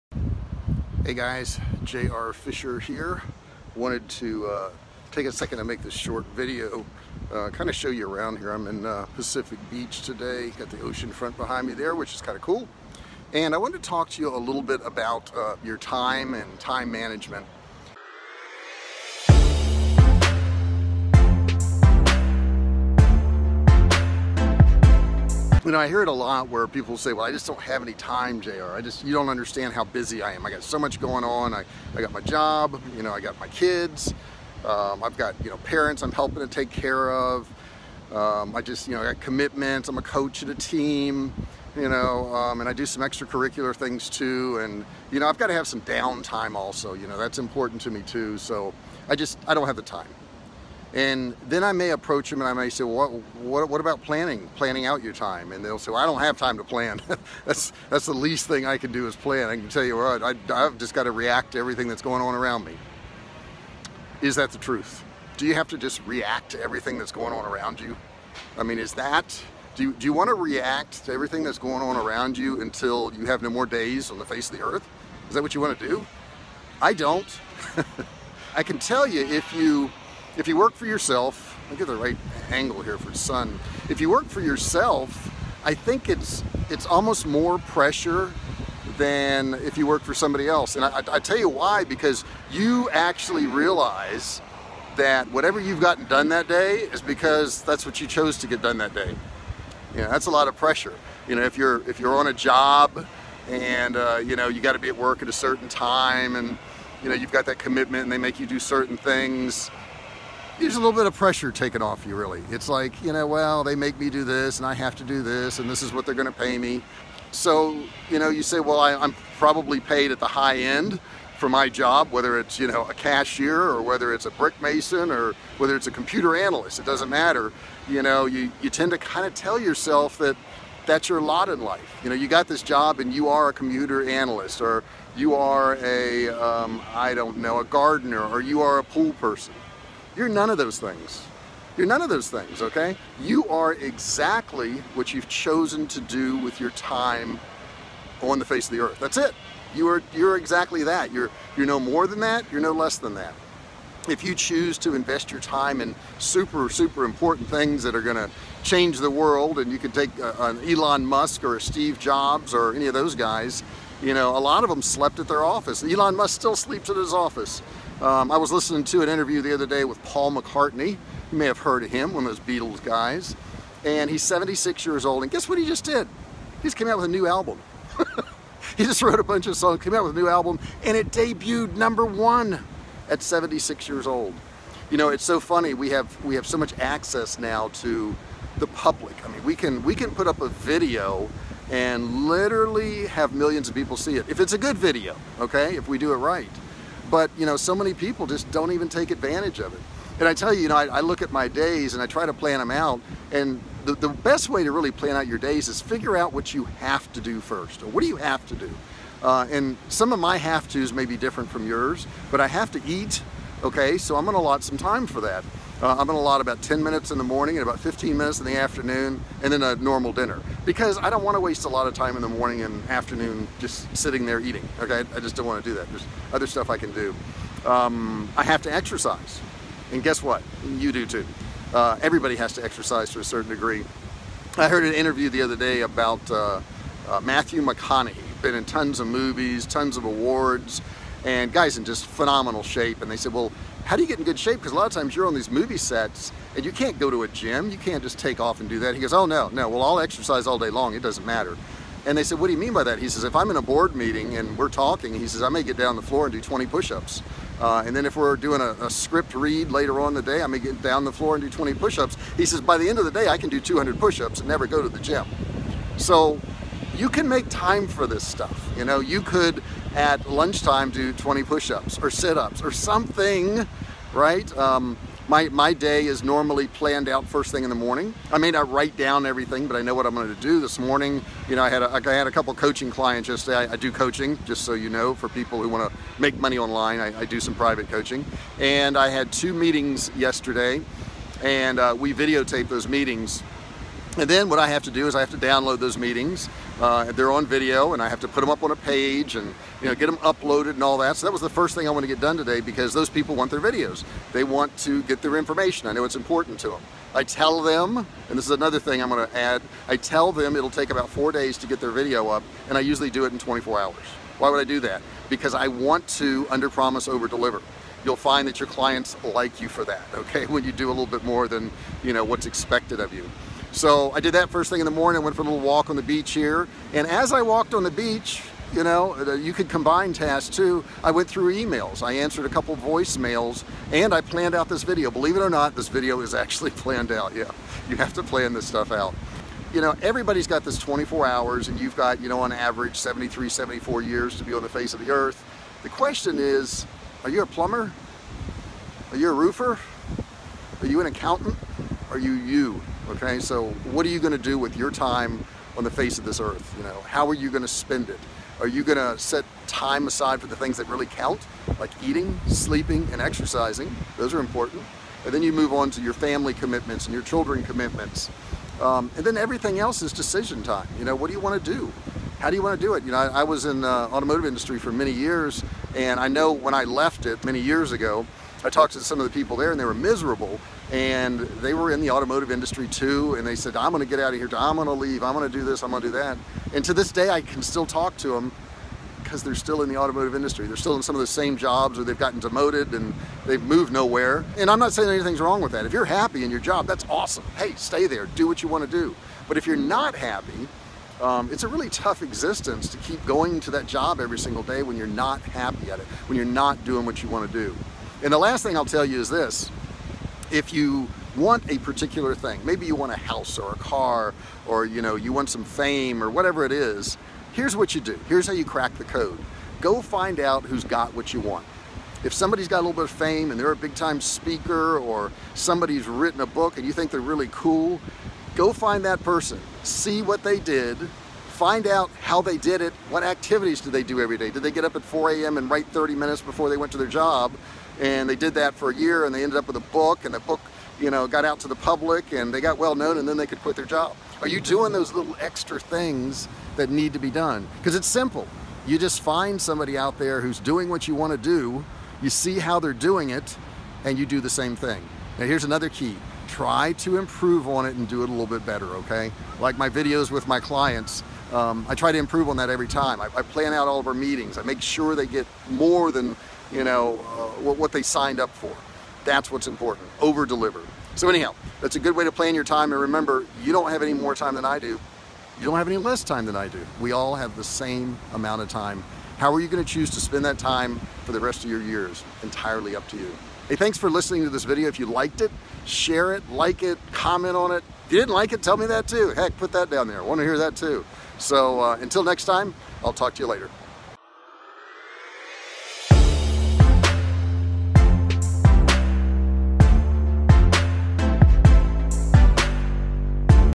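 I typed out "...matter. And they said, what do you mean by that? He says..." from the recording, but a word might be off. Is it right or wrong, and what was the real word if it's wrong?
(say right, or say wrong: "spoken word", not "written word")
right.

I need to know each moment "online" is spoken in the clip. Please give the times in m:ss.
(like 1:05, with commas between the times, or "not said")
4:46.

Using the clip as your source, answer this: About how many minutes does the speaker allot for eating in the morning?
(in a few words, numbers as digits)
10 minutes.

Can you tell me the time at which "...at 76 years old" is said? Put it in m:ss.
3:03.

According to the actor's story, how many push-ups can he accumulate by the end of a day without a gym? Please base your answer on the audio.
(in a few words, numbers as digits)
200.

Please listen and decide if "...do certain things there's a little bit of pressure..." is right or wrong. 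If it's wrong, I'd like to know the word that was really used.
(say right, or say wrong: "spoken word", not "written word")
right.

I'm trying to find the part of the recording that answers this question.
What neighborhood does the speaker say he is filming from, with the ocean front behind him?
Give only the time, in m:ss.
0:09.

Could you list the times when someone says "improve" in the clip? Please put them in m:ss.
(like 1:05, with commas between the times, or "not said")
7:37, 7:42.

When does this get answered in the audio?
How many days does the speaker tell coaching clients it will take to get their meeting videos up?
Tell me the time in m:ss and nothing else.
5:10.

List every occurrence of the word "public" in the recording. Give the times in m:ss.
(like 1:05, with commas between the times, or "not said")
3:08, 7:21.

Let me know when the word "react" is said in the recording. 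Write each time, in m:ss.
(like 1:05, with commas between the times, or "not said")
1:01, 1:06, 1:10.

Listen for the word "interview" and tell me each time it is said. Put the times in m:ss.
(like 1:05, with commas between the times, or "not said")
2:49, 3:54.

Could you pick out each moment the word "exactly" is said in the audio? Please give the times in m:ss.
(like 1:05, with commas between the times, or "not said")
2:23, 2:30.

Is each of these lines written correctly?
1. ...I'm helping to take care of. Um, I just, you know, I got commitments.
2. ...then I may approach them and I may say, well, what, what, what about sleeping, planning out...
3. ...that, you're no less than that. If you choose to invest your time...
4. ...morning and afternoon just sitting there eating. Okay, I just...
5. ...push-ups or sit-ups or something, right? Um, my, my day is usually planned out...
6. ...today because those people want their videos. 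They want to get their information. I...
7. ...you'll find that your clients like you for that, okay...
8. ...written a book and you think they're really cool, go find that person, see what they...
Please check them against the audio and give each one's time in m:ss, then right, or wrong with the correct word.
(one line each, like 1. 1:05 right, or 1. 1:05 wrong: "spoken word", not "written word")
1. 0:36 right
2. 0:51 wrong: "planning", not "sleeping"
3. 2:32 right
4. 3:42 right
5. 4:31 wrong: "normally", not "usually"
6. 5:02 right
7. 5:18 right
8. 7:06 right.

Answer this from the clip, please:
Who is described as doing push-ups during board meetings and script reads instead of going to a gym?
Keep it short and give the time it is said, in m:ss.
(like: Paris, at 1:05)
Matthew McConaughey, at 3:57.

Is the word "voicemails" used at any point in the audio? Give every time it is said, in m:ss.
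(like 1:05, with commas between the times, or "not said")
5:32.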